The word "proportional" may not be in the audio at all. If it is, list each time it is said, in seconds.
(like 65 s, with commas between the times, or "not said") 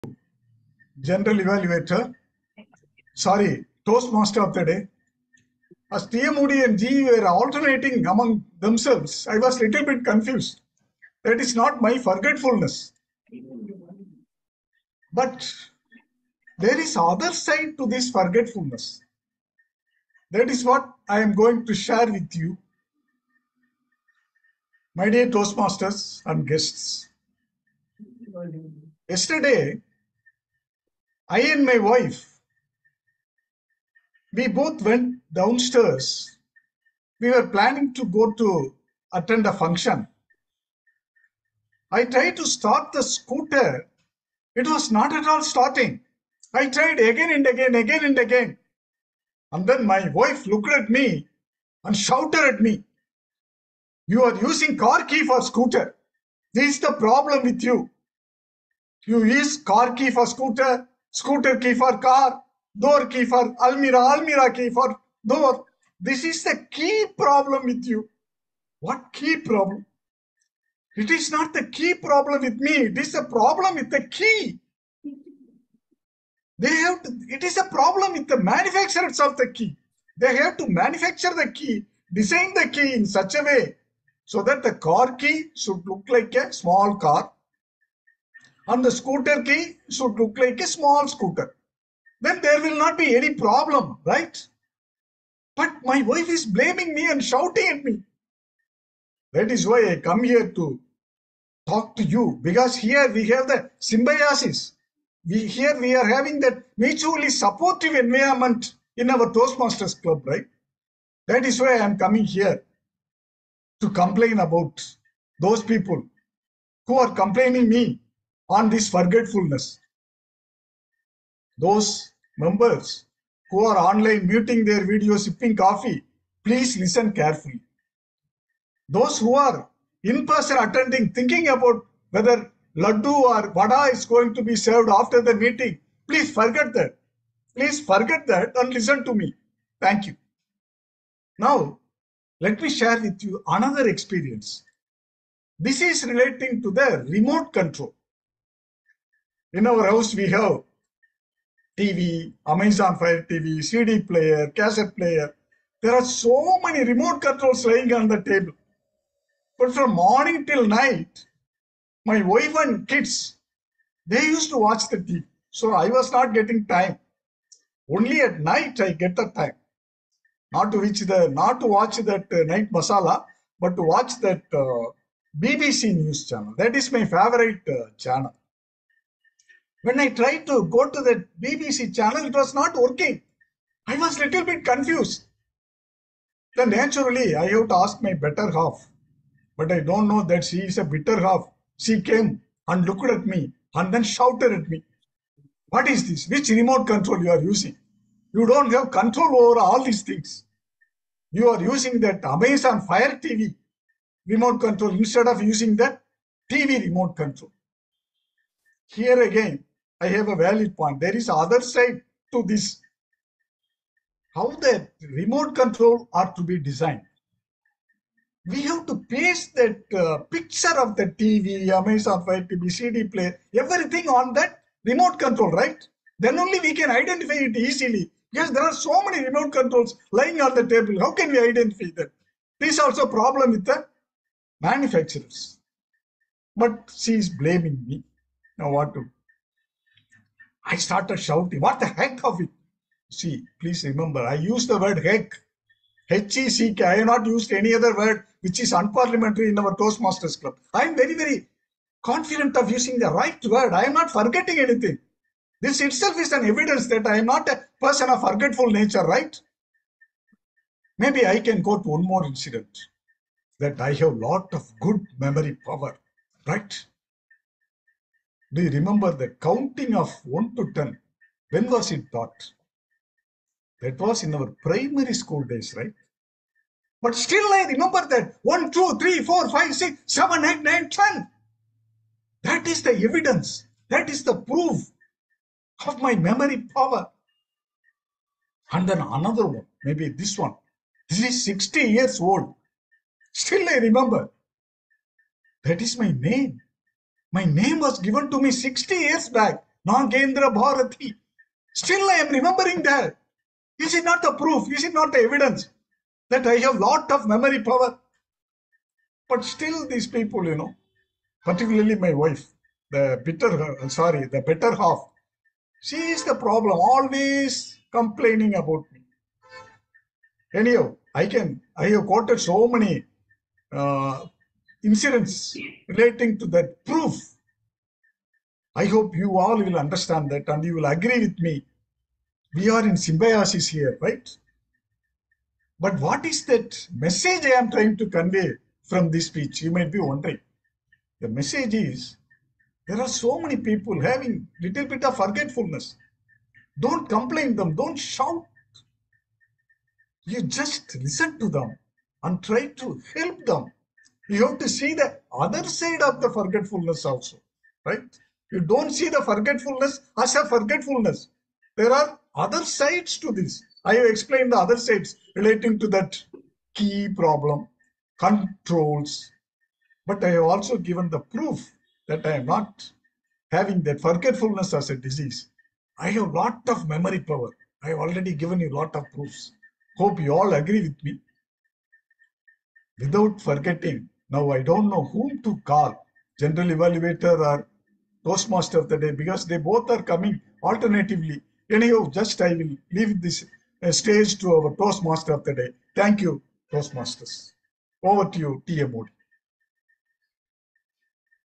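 not said.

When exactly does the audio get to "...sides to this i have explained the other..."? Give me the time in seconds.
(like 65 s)
362 s.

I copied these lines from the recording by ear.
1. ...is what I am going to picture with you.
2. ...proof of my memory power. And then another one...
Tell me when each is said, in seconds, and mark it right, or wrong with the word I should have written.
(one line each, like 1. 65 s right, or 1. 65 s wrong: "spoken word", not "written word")
1. 20 s wrong: "share", not "picture"
2. 284 s right.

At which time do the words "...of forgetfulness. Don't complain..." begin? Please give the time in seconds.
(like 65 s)
345 s.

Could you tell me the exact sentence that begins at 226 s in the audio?
Then only we can identify it easily.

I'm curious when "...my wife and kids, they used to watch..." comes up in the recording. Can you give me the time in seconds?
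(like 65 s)
162 s.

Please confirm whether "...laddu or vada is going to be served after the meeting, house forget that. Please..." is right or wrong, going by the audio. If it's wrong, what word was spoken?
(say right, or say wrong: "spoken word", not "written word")
wrong: "please", not "house".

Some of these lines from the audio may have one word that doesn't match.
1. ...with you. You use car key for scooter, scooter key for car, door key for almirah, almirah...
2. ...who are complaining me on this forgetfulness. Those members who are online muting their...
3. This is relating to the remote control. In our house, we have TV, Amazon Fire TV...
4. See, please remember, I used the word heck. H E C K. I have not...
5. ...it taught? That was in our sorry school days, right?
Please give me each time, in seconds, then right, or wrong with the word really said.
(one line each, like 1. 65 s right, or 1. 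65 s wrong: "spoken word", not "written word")
1. 57 s right
2. 116 s right
3. 145 s right
4. 243 s right
5. 271 s wrong: "primary", not "sorry".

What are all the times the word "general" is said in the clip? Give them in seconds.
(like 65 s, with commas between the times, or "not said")
1 s, 386 s.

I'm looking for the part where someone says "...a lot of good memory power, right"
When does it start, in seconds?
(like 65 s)
264 s.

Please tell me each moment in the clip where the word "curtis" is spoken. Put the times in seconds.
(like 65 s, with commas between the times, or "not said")
not said.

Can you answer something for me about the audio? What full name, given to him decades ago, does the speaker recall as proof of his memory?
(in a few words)
Nagendra Bharathi.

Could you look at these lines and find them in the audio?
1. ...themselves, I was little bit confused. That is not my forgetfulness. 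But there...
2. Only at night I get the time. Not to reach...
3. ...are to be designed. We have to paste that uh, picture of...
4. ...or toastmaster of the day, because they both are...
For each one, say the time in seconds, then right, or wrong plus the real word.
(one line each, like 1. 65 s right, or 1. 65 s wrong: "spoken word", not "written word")
1. 8 s right
2. 167 s right
3. 216 s right
4. 387 s right.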